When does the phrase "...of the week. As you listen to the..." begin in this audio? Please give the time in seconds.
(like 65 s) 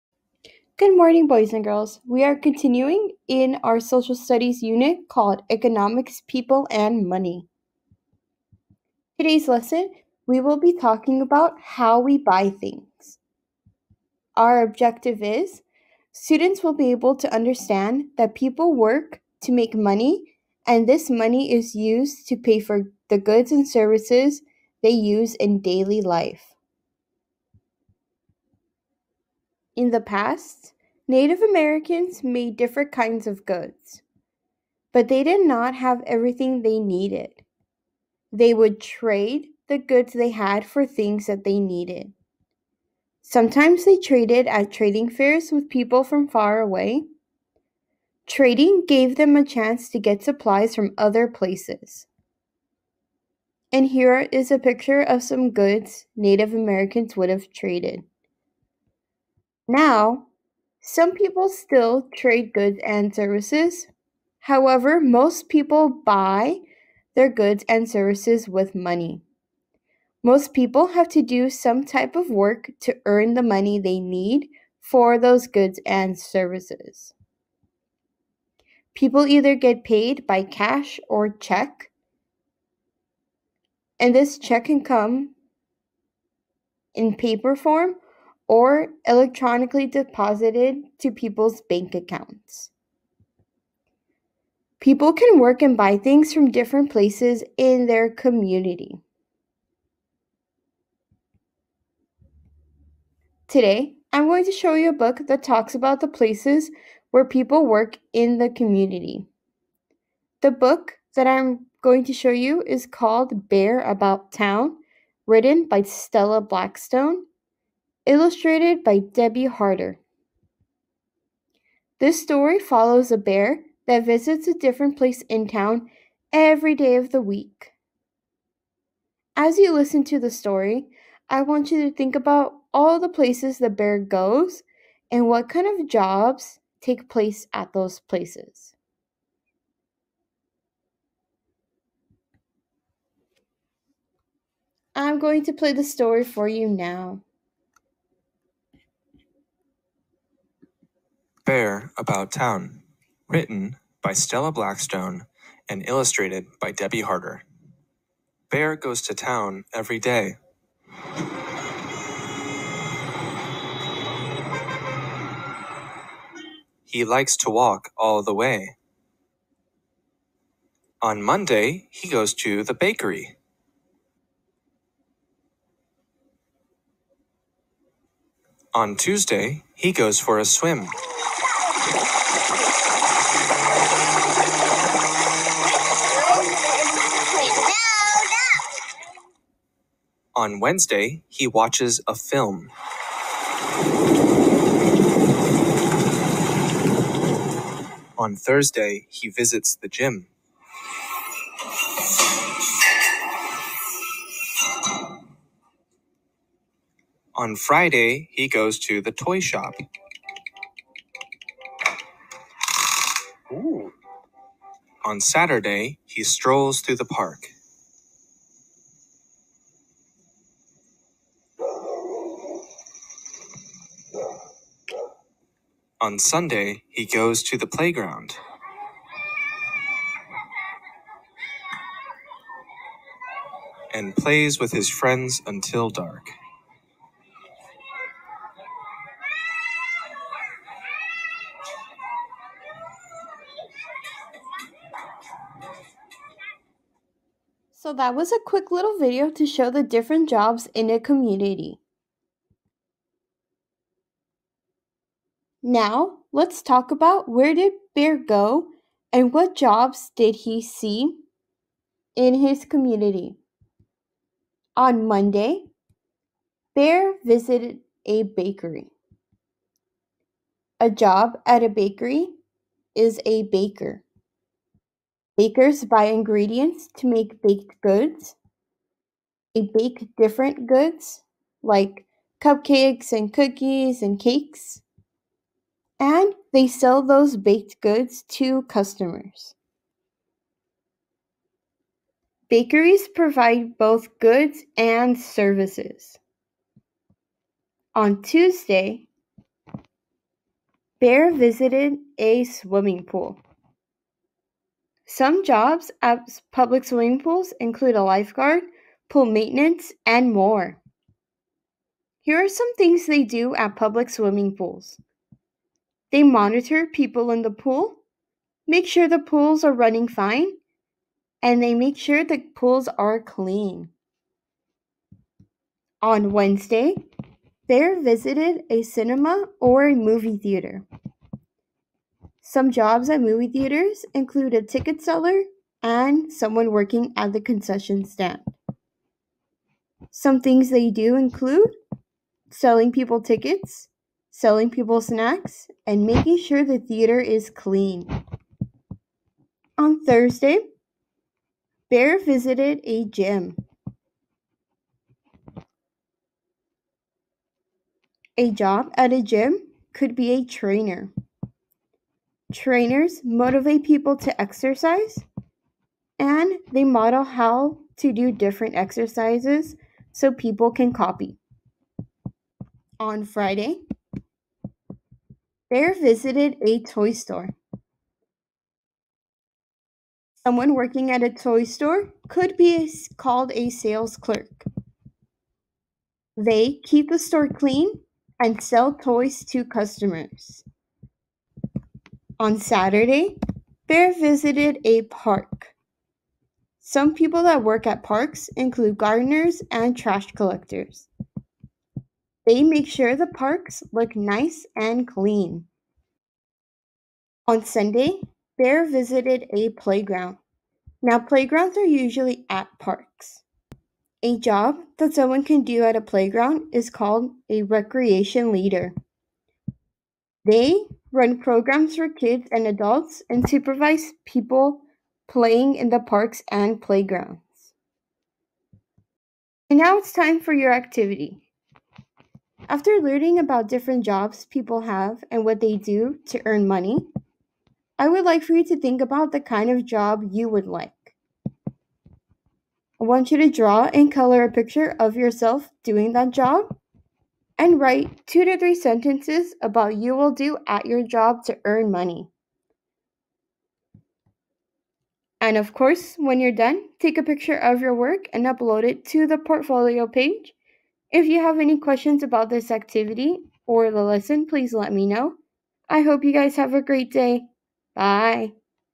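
126 s.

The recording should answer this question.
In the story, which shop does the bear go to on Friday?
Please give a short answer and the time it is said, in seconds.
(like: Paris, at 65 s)
the toy shop, at 209 s.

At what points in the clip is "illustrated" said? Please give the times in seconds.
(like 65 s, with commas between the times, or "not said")
118 s, 155 s.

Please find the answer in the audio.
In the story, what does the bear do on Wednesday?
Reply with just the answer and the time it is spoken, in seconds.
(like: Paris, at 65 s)
watches a film, at 191 s.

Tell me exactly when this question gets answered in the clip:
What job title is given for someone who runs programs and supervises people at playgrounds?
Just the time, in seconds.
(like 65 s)
417 s.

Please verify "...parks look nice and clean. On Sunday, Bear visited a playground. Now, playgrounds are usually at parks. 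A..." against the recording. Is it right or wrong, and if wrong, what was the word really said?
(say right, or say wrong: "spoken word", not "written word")
right.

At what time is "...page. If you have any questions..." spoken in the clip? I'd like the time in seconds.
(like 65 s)
460 s.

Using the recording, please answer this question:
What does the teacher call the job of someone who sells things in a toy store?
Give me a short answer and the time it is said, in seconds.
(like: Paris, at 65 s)
sales clerk, at 383 s.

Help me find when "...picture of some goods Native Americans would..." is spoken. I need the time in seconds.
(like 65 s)
54 s.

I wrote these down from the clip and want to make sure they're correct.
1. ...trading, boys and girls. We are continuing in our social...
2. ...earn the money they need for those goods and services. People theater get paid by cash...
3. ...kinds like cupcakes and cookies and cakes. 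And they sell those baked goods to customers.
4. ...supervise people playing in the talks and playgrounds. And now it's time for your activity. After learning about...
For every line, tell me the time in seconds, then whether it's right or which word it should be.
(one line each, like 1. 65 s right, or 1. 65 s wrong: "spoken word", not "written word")
1. 0 s wrong: "morning", not "trading"
2. 73 s wrong: "either", not "theater"
3. 280 s wrong: "goods", not "kinds"
4. 423 s wrong: "parks", not "talks".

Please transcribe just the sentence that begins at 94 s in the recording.
People can work and buy things from different places in their community.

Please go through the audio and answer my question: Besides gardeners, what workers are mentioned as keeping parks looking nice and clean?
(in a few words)
trash collectors.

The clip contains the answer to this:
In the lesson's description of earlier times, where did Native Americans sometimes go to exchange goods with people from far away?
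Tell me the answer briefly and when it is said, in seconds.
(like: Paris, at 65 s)
trading fairs, at 44 s.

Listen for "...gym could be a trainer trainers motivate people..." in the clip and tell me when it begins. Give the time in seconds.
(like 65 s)
359 s.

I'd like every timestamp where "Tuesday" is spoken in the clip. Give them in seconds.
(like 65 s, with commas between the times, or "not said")
178 s, 298 s.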